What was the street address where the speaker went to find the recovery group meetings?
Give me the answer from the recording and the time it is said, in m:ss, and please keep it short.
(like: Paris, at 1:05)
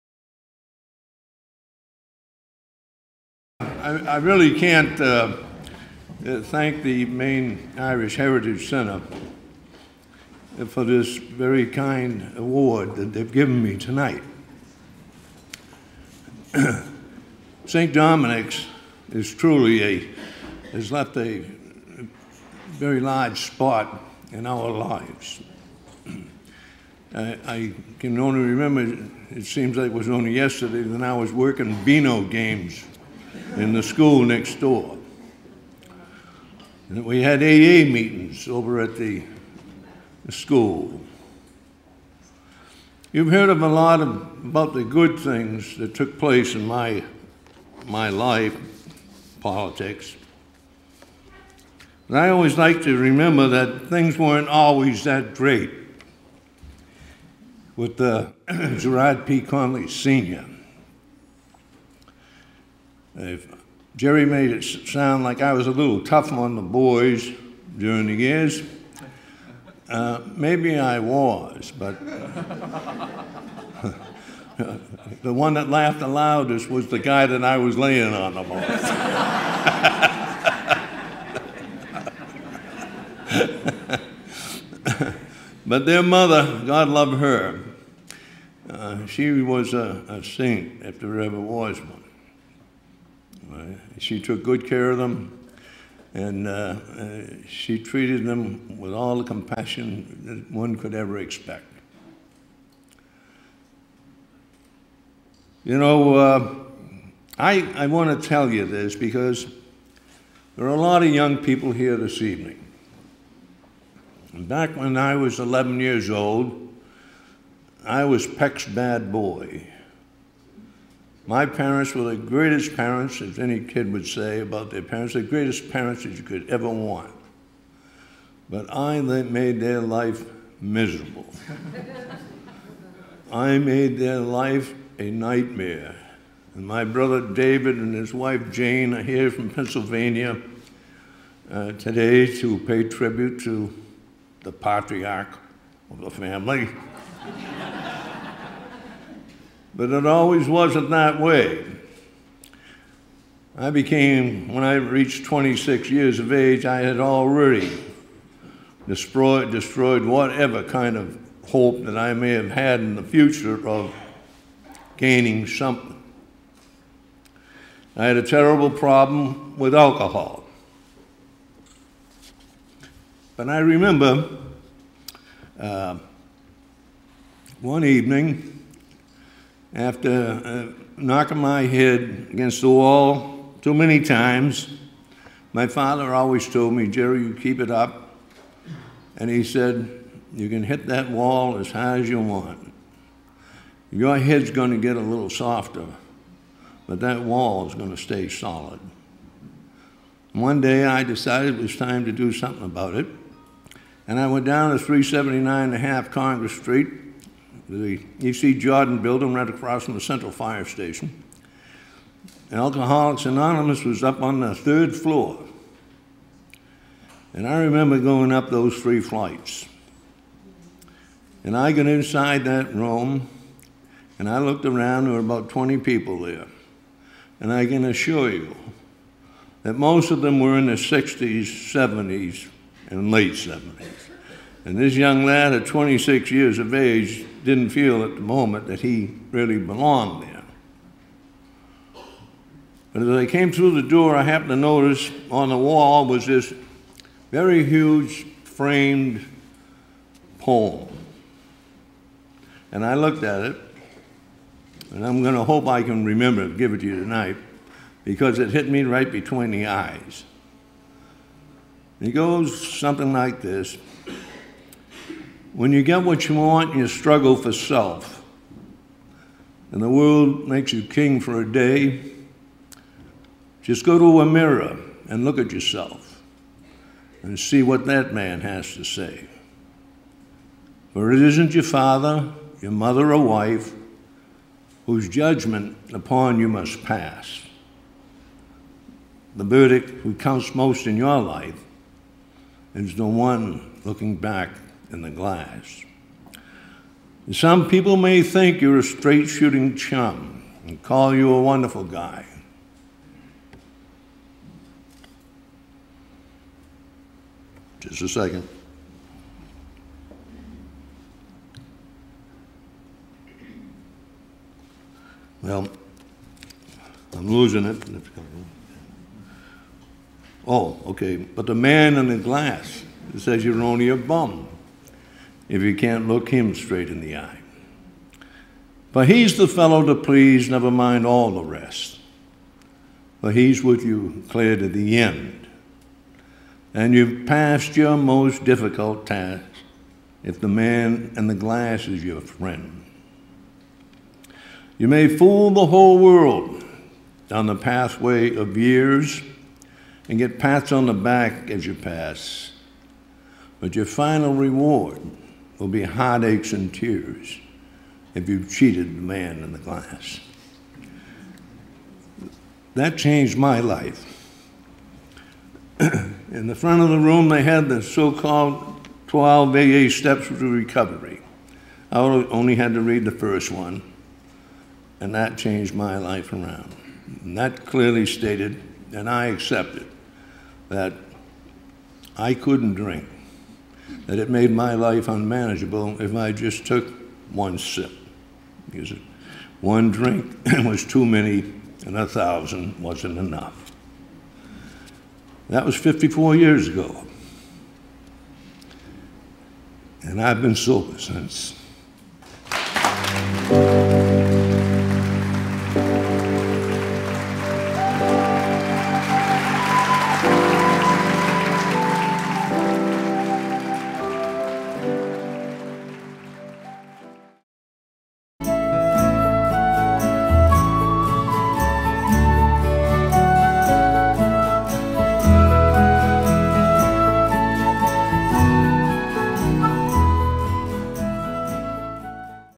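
379 and a half Congress Street, at 3:24.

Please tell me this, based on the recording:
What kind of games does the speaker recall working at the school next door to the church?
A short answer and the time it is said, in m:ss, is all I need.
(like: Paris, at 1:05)
Beano, at 0:31.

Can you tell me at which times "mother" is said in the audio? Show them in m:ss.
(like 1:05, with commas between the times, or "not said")
1:26, 4:42.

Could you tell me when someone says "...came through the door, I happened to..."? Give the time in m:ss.
4:03.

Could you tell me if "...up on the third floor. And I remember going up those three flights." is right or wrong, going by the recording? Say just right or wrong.
right.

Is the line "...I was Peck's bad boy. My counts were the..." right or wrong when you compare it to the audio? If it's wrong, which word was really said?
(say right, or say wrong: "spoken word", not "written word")
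wrong: "parents", not "counts".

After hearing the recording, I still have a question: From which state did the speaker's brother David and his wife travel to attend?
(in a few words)
Pennsylvania.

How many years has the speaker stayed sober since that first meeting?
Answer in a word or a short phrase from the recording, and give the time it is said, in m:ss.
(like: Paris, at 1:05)
54, at 6:35.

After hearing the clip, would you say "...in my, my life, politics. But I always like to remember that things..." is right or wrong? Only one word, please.
right.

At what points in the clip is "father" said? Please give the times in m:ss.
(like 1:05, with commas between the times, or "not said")
3:05, 4:41.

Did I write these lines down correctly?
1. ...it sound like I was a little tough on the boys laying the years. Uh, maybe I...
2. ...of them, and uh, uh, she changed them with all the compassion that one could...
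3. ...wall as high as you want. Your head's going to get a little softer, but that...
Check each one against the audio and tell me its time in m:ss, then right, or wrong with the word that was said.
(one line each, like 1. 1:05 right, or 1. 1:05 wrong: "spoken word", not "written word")
1. 1:04 wrong: "during", not "laying"
2. 1:34 wrong: "treated", not "changed"
3. 3:11 right.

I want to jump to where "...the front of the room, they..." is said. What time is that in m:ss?
6:06.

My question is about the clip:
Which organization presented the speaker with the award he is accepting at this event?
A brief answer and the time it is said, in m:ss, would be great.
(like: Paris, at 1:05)
Maine Irish Heritage Center, at 0:07.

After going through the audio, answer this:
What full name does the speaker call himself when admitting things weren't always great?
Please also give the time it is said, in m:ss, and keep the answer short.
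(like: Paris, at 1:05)
Gerard P. Conley Sr., at 0:58.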